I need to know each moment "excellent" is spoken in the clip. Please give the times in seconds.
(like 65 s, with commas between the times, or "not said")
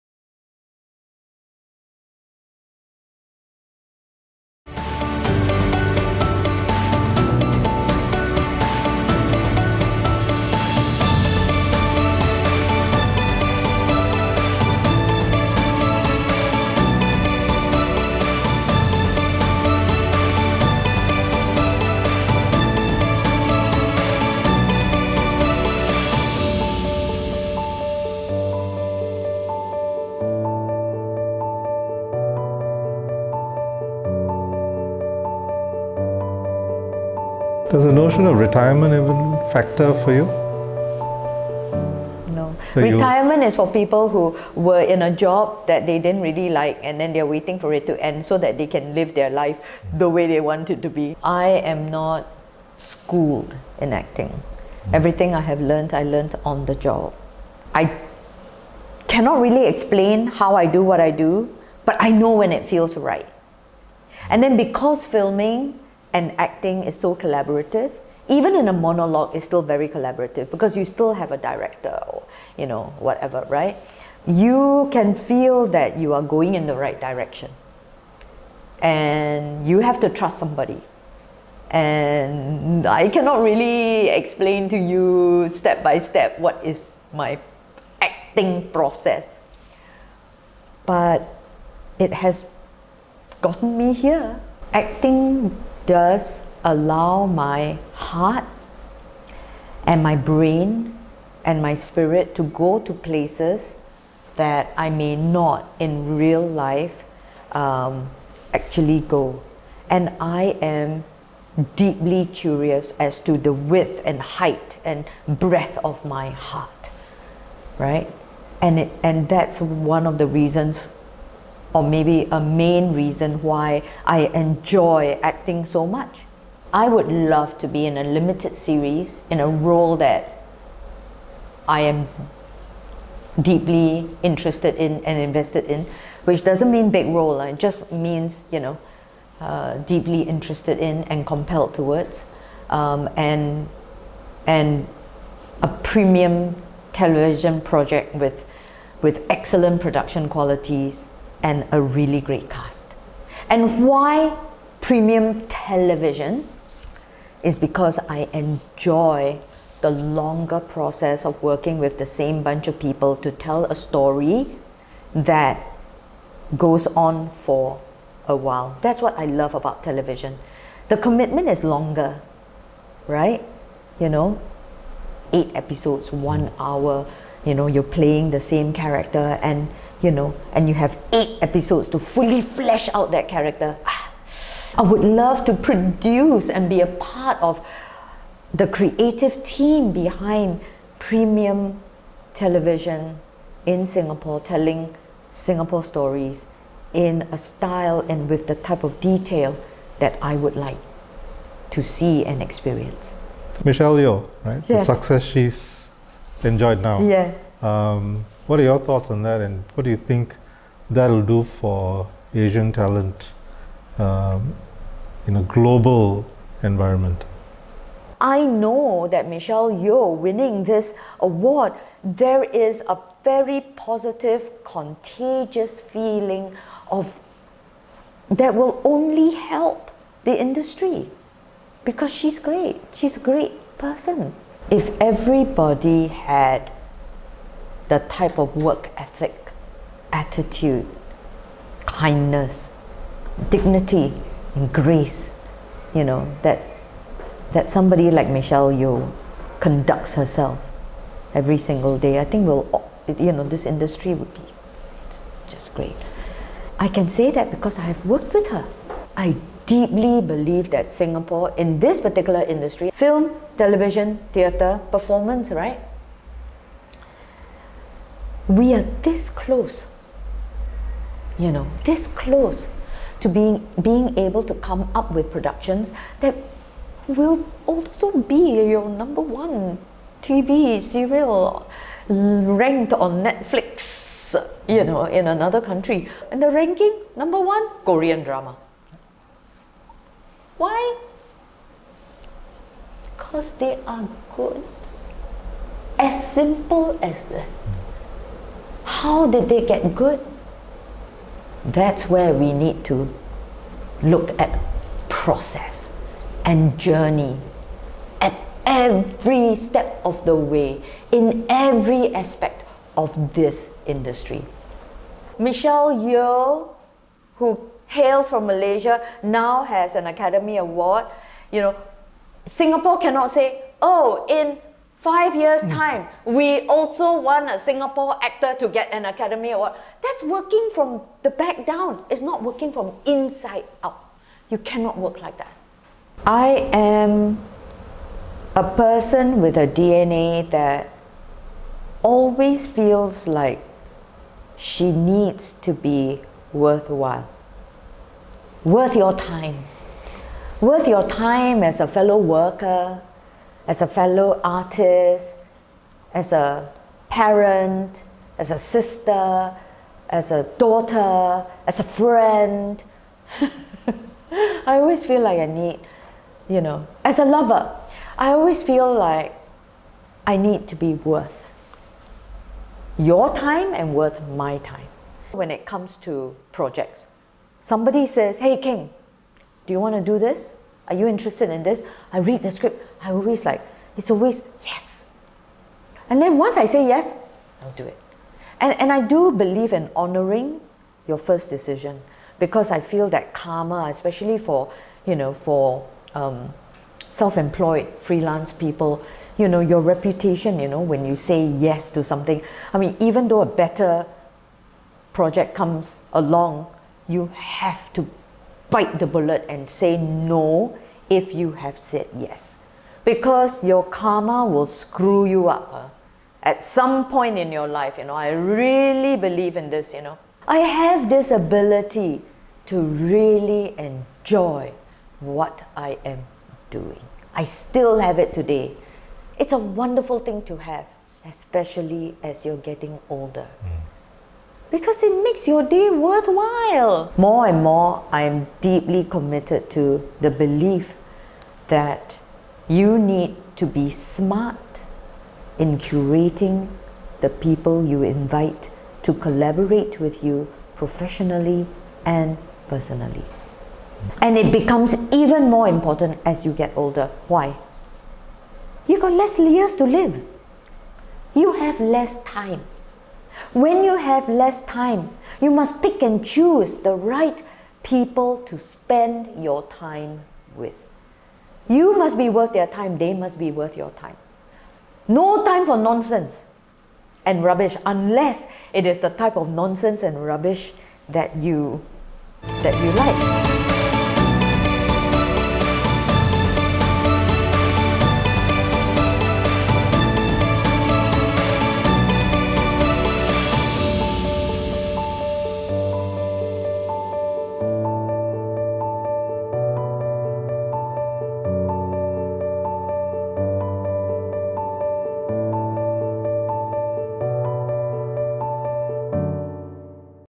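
149 s.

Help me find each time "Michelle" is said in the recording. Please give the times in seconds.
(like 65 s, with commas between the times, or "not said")
203 s, 219 s, 248 s, 315 s.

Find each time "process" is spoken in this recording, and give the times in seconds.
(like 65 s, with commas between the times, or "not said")
88 s, 160 s, 305 s.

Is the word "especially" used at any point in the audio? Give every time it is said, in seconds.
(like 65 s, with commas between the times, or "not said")
393 s, 431 s.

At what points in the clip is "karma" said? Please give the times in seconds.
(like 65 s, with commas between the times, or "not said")
393 s, 413 s.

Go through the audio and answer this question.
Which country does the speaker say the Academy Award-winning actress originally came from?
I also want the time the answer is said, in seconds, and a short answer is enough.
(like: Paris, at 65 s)
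Malaysia, at 318 s.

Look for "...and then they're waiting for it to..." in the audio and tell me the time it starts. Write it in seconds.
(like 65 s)
46 s.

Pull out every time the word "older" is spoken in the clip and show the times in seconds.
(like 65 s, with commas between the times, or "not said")
433 s, 456 s.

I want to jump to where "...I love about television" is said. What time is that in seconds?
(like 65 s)
169 s.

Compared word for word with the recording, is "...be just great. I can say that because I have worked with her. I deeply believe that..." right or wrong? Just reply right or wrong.
right.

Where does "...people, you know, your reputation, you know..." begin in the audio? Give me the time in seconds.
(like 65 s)
398 s.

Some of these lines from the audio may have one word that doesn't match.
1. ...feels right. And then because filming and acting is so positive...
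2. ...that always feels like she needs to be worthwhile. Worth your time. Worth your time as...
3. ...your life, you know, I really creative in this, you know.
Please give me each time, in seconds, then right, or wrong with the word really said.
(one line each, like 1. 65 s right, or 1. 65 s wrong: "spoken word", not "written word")
1. 62 s wrong: "collaborative", not "positive"
2. 340 s right
3. 417 s wrong: "believe", not "creative".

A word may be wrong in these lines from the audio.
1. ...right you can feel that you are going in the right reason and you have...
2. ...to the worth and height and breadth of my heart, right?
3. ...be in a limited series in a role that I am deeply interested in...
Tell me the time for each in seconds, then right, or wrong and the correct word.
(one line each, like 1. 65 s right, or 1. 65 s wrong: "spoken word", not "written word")
1. 73 s wrong: "direction", not "reason"
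2. 113 s wrong: "width", not "worth"
3. 127 s right.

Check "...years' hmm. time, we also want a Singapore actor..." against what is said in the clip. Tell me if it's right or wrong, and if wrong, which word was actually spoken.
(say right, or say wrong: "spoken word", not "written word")
right.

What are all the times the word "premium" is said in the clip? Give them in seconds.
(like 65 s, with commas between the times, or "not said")
145 s, 154 s, 190 s.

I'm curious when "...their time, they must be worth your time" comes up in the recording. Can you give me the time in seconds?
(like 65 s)
472 s.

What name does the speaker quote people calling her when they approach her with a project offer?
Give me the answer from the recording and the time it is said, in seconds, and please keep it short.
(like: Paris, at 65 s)
Kheng, at 378 s.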